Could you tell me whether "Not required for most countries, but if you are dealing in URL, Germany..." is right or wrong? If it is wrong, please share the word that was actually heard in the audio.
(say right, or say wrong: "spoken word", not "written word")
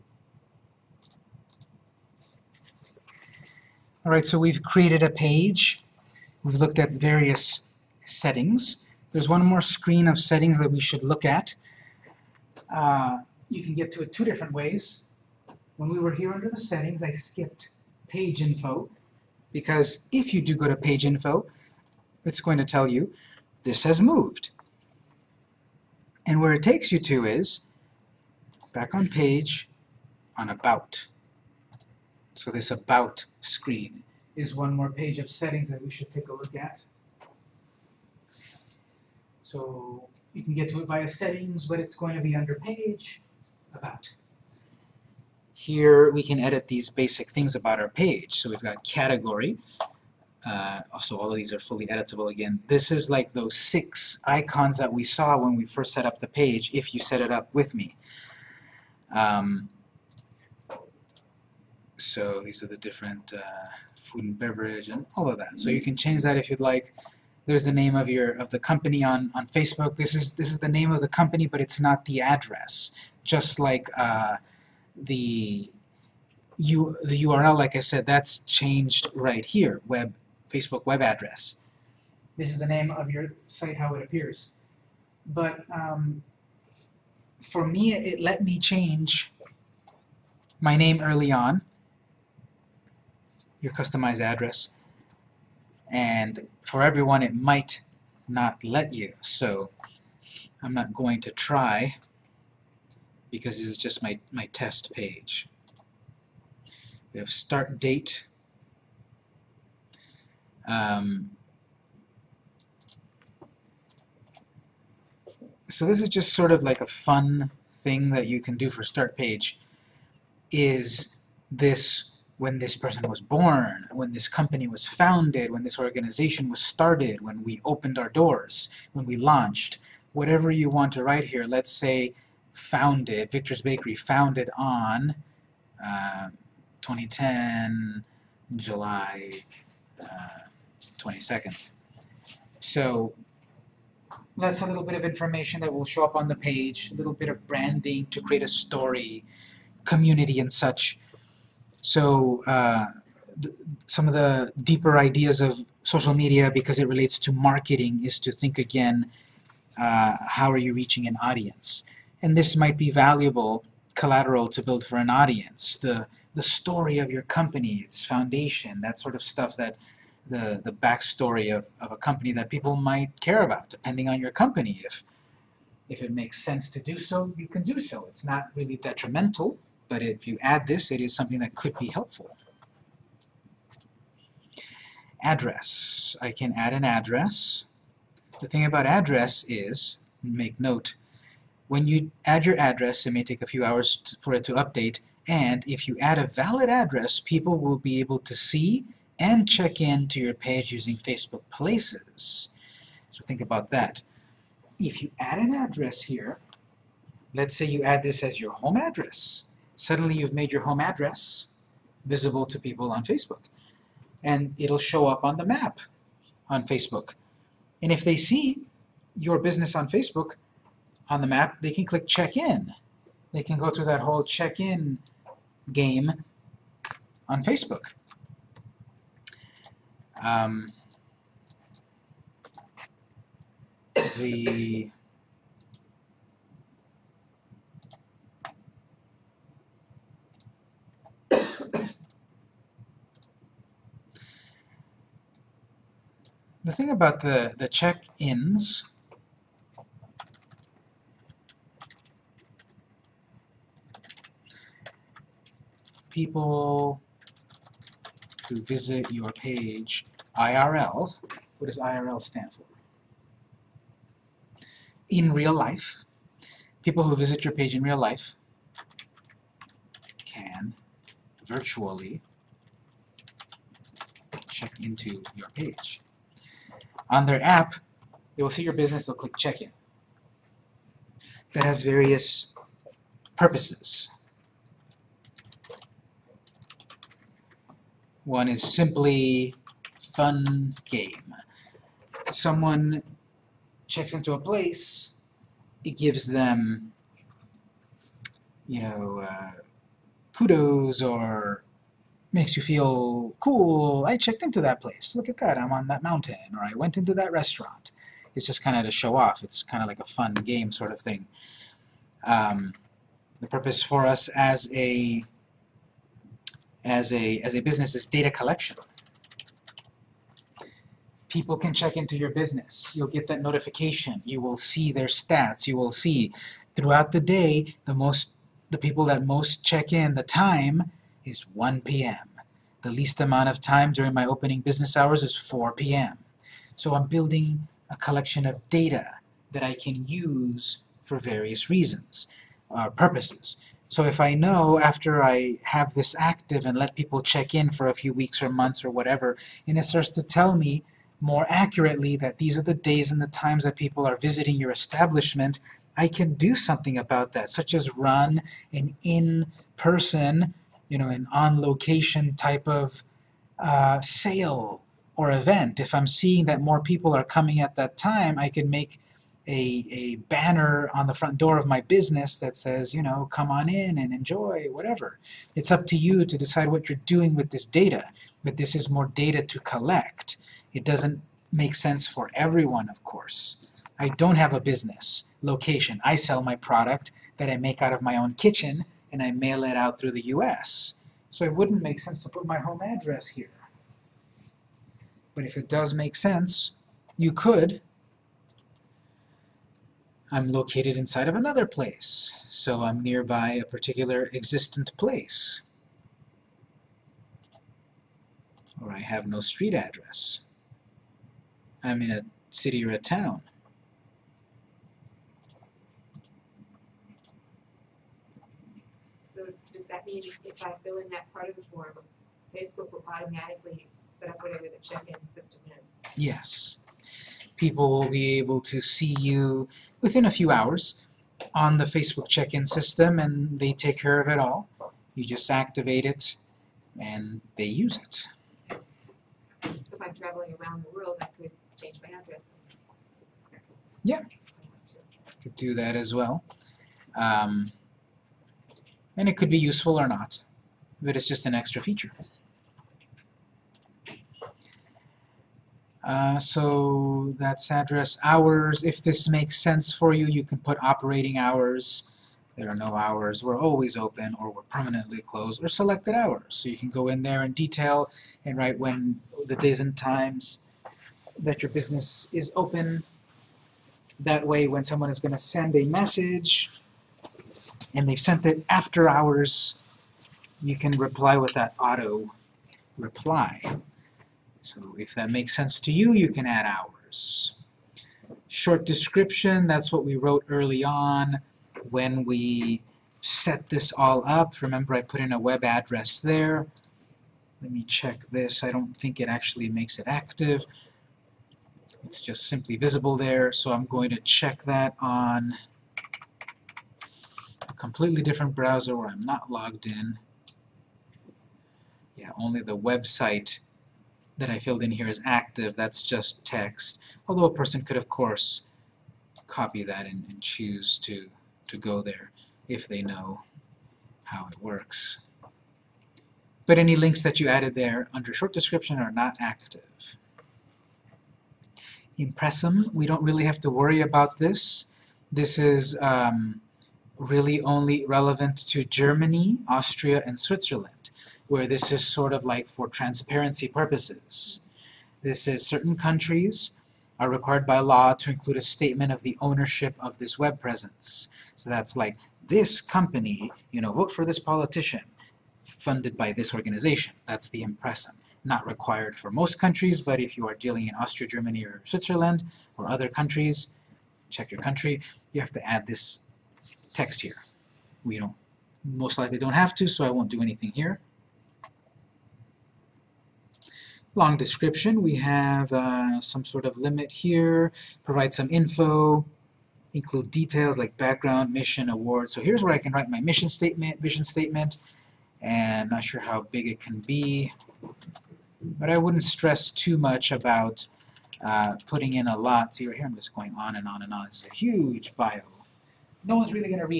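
wrong: "Austria", not "URL".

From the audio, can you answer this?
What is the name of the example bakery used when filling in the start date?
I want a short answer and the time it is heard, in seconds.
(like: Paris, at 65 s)
Victor's Bakery, at 133 s.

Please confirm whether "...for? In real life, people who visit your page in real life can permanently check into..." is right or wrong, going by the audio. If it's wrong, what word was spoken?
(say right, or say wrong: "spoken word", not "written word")
wrong: "virtually", not "permanently".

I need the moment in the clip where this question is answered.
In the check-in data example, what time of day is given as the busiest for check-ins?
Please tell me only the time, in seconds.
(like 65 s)
331 s.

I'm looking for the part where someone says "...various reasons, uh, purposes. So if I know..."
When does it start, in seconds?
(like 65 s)
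341 s.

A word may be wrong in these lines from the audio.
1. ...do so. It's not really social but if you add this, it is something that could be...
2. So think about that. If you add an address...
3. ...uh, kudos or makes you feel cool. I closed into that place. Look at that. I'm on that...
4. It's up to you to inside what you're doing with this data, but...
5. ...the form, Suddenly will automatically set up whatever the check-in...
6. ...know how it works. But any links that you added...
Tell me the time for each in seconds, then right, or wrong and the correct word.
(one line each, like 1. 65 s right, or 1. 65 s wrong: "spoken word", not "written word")
1. 177 s wrong: "detrimental", not "social"
2. 203 s right
3. 299 s wrong: "checked", not "closed"
4. 375 s wrong: "decide", not "inside"
5. 421 s wrong: "Facebook", not "Suddenly"
6. 523 s right.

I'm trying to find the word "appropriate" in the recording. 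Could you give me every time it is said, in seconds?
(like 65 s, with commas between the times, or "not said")
not said.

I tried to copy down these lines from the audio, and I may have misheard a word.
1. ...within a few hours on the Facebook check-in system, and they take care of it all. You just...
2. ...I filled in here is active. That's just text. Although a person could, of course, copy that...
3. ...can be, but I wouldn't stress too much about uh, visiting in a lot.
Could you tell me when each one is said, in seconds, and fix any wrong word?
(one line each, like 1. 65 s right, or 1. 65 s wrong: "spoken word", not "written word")
1. 430 s right
2. 514 s right
3. 586 s wrong: "putting", not "visiting".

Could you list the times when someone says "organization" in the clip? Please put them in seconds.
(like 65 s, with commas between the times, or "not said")
125 s, 556 s.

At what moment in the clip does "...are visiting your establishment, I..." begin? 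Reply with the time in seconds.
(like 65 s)
354 s.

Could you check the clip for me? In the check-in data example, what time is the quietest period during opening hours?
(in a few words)
4 p.m.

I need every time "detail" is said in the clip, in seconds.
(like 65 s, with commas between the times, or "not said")
467 s, 580 s.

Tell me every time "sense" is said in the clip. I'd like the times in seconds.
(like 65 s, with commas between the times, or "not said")
176 s, 381 s, 391 s, 396 s, 459 s, 485 s.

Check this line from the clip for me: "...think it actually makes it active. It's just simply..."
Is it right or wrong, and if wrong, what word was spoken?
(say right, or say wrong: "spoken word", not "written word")
right.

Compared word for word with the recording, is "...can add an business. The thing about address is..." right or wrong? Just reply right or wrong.
wrong.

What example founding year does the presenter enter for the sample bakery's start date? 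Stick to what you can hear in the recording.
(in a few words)
2010.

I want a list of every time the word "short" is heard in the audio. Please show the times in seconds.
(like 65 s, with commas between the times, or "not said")
488 s, 528 s.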